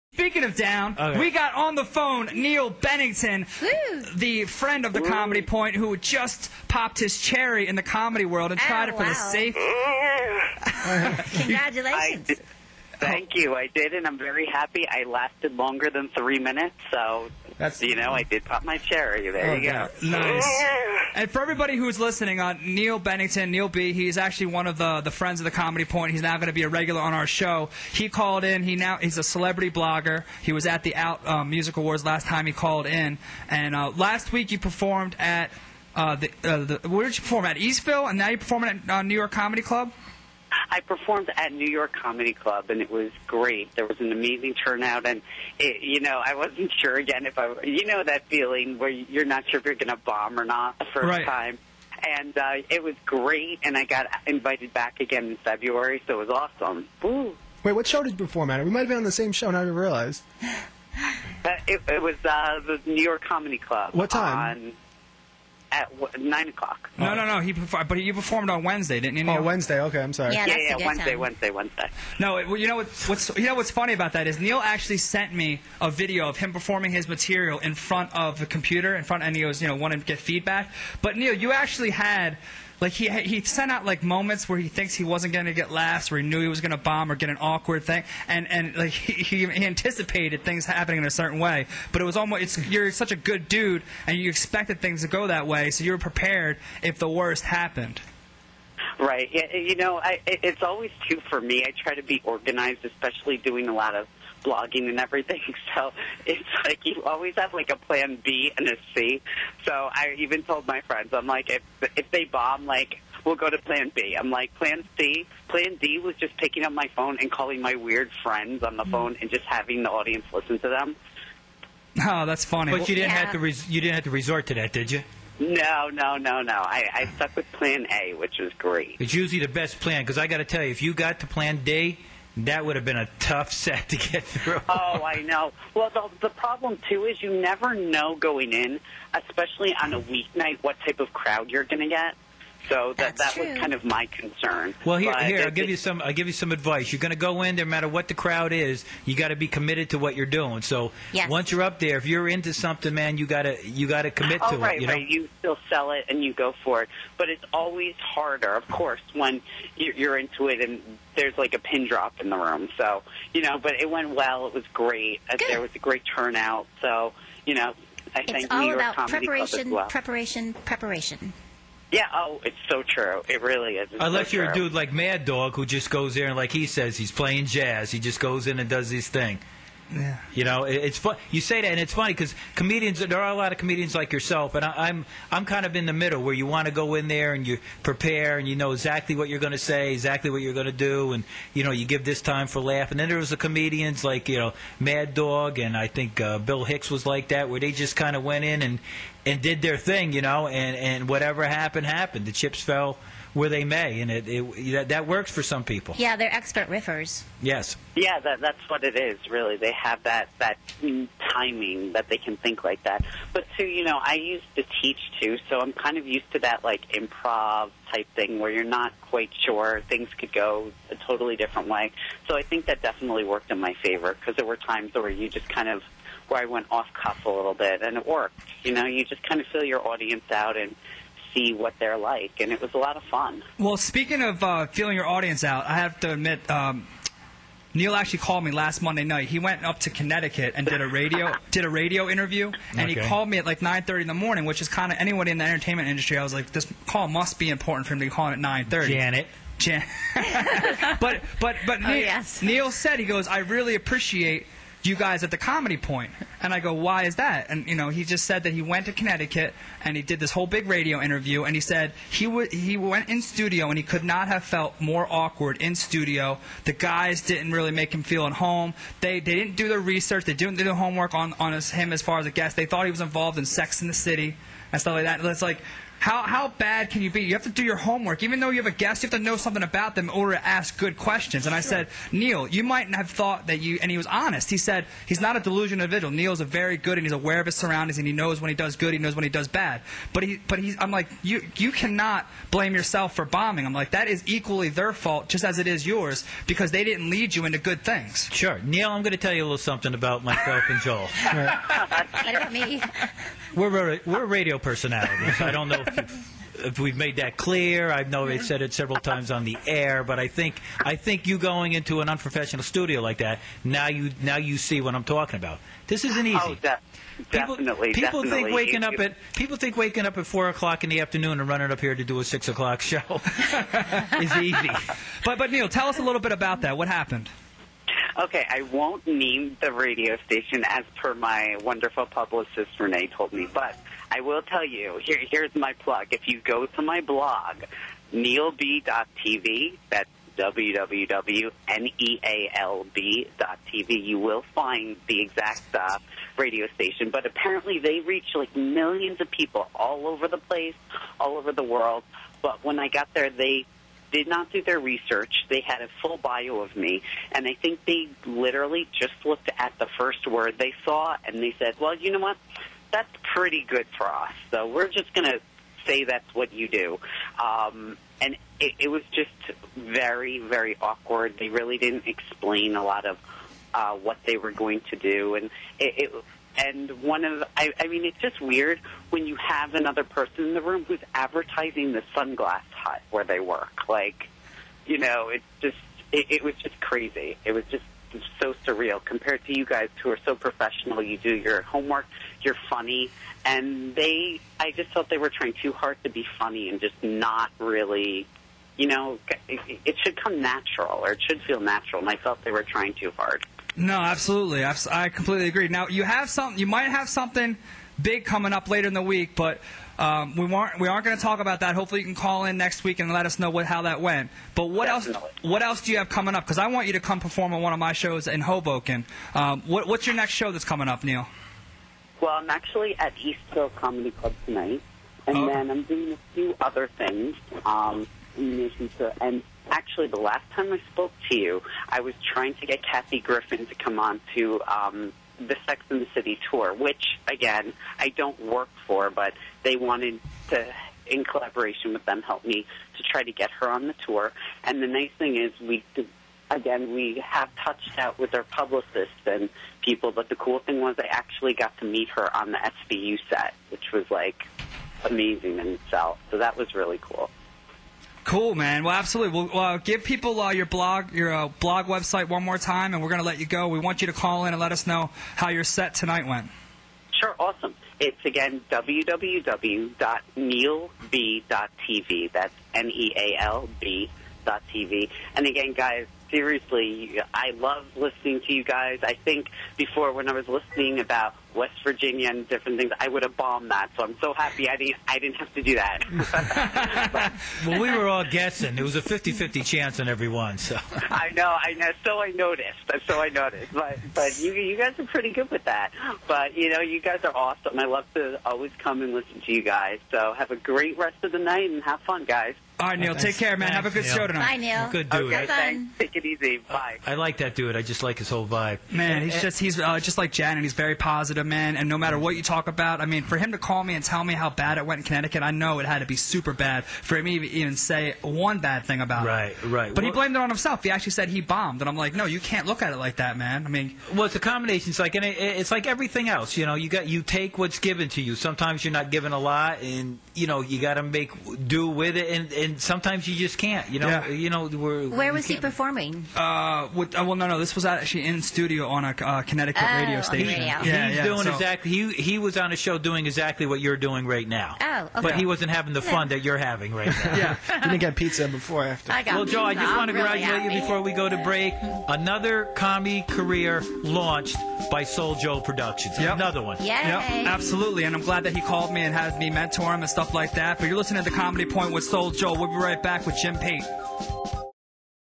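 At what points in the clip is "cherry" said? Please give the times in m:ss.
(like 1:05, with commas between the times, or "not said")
0:07, 0:18.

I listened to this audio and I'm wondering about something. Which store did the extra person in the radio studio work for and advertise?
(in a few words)
Sunglass Hut.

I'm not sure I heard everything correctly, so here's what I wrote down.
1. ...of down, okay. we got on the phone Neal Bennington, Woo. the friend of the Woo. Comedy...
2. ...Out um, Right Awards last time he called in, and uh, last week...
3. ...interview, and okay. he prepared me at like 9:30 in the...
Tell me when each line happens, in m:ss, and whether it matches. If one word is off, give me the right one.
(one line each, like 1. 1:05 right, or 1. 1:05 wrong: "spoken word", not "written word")
1. 0:00 right
2. 0:30 wrong: "Music", not "Right"
3. 4:02 wrong: "called", not "prepared".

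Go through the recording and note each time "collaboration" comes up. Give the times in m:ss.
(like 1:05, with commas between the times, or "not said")
7:21.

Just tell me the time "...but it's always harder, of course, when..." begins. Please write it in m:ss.
2:37.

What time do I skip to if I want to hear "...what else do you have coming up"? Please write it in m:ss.
6:55.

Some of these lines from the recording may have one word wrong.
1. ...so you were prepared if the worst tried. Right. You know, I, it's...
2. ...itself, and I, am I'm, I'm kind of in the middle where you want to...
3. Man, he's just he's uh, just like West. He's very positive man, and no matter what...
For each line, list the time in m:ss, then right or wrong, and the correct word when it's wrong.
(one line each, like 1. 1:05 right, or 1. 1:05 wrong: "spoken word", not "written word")
1. 1:35 wrong: "happened", not "tried"
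2. 3:04 wrong: "yourself", not "itself"
3. 8:28 wrong: "Janet", not "West".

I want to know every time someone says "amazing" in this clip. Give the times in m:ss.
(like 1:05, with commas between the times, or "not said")
0:44, 7:35.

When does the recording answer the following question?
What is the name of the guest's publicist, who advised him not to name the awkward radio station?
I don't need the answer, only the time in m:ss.
5:32.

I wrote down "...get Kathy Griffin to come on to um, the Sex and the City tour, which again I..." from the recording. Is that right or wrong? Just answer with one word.
right.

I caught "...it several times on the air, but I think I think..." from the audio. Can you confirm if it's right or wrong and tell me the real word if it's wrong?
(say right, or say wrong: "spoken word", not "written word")
right.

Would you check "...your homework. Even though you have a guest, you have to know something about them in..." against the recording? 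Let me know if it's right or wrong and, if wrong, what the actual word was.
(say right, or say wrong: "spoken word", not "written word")
right.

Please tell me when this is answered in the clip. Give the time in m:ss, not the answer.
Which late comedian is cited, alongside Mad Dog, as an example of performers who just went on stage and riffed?
3:16.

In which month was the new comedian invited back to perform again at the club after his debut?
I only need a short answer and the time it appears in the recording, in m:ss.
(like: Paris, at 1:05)
February, at 0:55.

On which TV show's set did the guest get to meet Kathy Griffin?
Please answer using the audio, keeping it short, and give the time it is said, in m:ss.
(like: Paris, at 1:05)
SVU, at 7:32.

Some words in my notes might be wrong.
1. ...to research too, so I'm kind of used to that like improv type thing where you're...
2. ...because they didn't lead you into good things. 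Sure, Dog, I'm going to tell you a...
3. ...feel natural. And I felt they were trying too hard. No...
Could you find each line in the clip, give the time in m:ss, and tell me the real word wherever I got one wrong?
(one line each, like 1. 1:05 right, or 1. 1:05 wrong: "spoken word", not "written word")
1. 3:34 wrong: "teach", not "research"
2. 4:56 wrong: "Neal", not "Dog"
3. 6:41 right.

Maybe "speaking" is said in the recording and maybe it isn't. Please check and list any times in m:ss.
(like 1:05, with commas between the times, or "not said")
0:00, 3:53.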